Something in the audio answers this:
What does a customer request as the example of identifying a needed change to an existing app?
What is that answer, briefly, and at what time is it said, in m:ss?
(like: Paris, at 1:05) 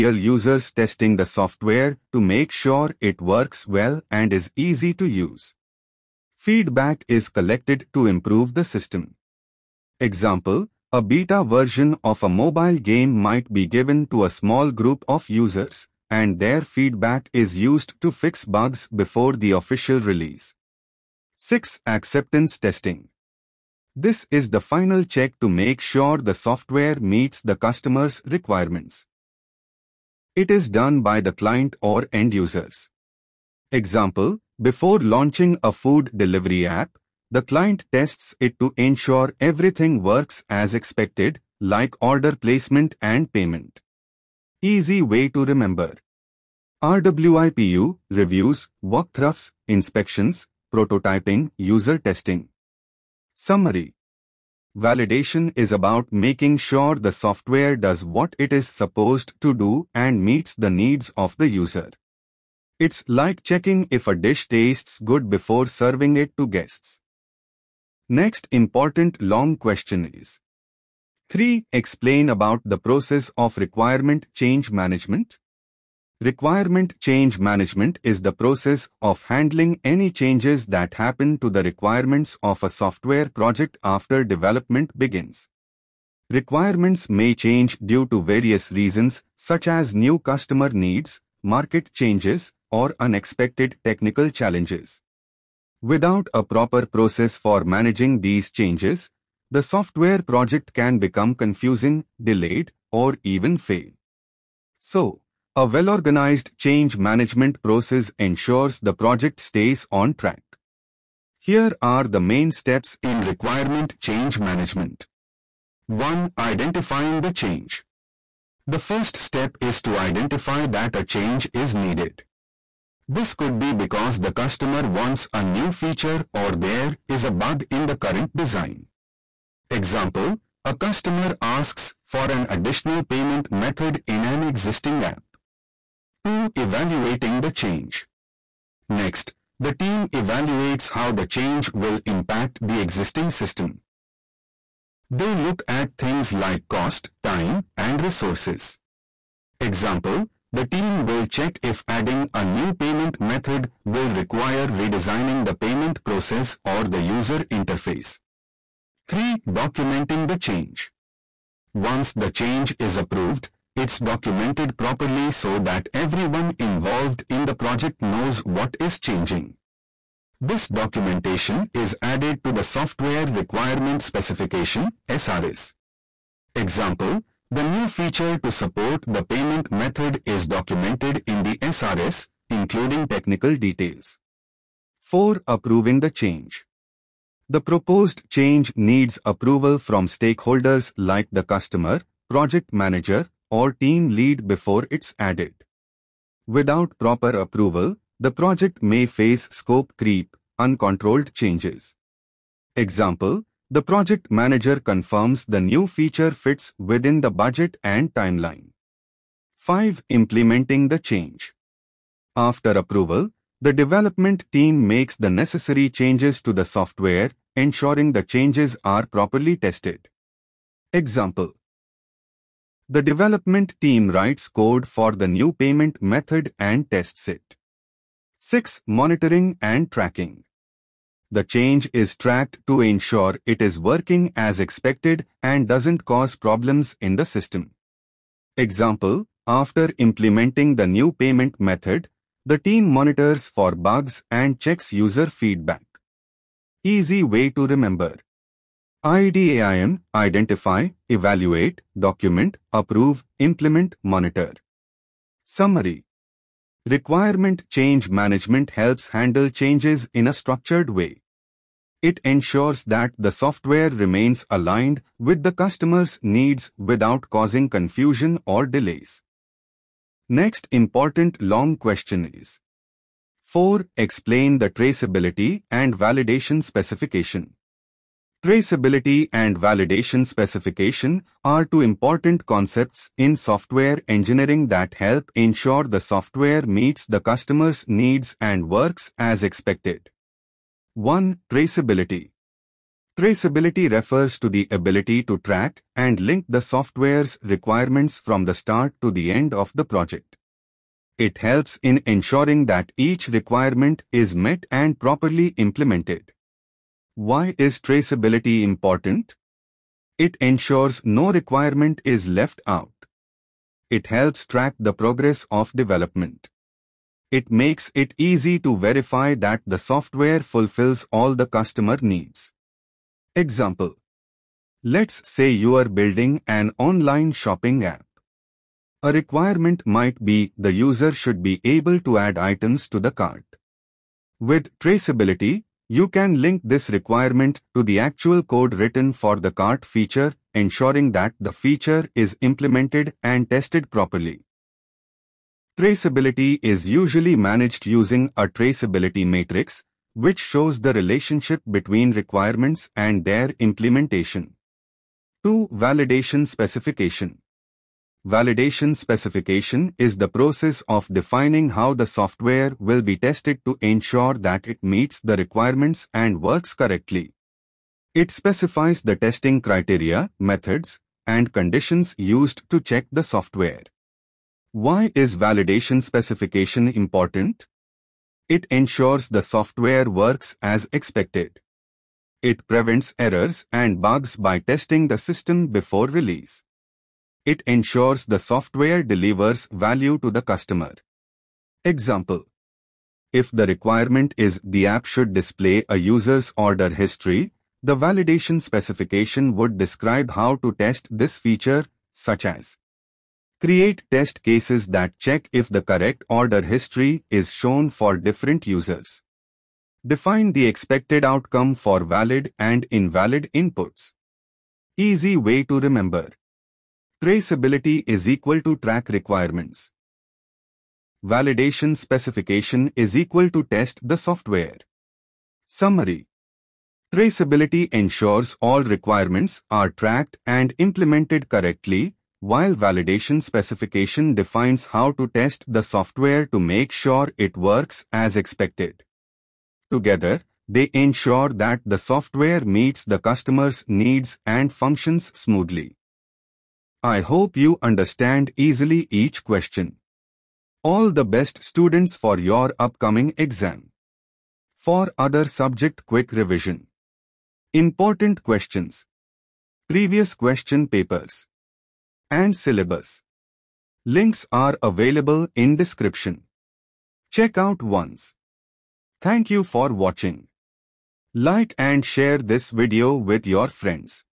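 additional payment method, at 2:12.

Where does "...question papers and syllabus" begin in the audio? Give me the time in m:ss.
7:40.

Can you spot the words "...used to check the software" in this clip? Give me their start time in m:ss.
6:12.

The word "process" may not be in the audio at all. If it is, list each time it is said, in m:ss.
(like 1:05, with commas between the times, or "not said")
1:12, 1:18, 1:36, 1:47, 2:36, 6:00.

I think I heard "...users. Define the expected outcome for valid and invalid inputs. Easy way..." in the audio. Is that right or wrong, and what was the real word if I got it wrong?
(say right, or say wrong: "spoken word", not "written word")
right.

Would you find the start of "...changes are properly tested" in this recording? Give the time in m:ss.
3:38.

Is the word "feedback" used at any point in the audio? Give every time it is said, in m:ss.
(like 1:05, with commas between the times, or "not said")
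0:06, 0:16, 4:05.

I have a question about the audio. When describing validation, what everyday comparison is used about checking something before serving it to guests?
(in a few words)
checking if a dish tastes good.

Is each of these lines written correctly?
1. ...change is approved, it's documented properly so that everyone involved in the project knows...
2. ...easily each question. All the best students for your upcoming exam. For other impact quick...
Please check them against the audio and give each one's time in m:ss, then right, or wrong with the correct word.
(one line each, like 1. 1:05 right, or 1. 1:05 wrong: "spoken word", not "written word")
1. 2:42 right
2. 7:28 wrong: "subject", not "impact".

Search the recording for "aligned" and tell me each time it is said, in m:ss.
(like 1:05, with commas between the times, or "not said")
4:24.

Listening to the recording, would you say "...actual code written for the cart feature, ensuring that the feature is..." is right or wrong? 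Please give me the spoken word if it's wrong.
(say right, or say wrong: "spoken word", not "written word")
right.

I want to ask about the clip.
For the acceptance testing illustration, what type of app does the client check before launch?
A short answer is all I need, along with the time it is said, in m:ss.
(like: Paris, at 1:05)
food delivery app, at 0:35.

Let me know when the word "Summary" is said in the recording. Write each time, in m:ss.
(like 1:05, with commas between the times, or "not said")
0:53, 4:15, 7:05.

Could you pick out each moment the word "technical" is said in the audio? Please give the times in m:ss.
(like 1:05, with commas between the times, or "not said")
1:33, 3:03.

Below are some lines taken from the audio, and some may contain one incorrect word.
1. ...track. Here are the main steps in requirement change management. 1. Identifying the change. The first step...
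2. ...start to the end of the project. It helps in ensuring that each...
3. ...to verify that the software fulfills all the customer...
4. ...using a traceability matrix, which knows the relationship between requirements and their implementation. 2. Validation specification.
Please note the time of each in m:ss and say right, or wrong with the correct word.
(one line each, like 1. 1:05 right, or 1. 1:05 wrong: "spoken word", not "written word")
1. 1:50 right
2. 4:58 right
3. 5:18 right
4. 5:47 wrong: "shows", not "knows".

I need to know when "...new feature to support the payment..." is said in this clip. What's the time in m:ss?
2:57.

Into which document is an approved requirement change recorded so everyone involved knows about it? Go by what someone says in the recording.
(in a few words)
Software Requirement Specification.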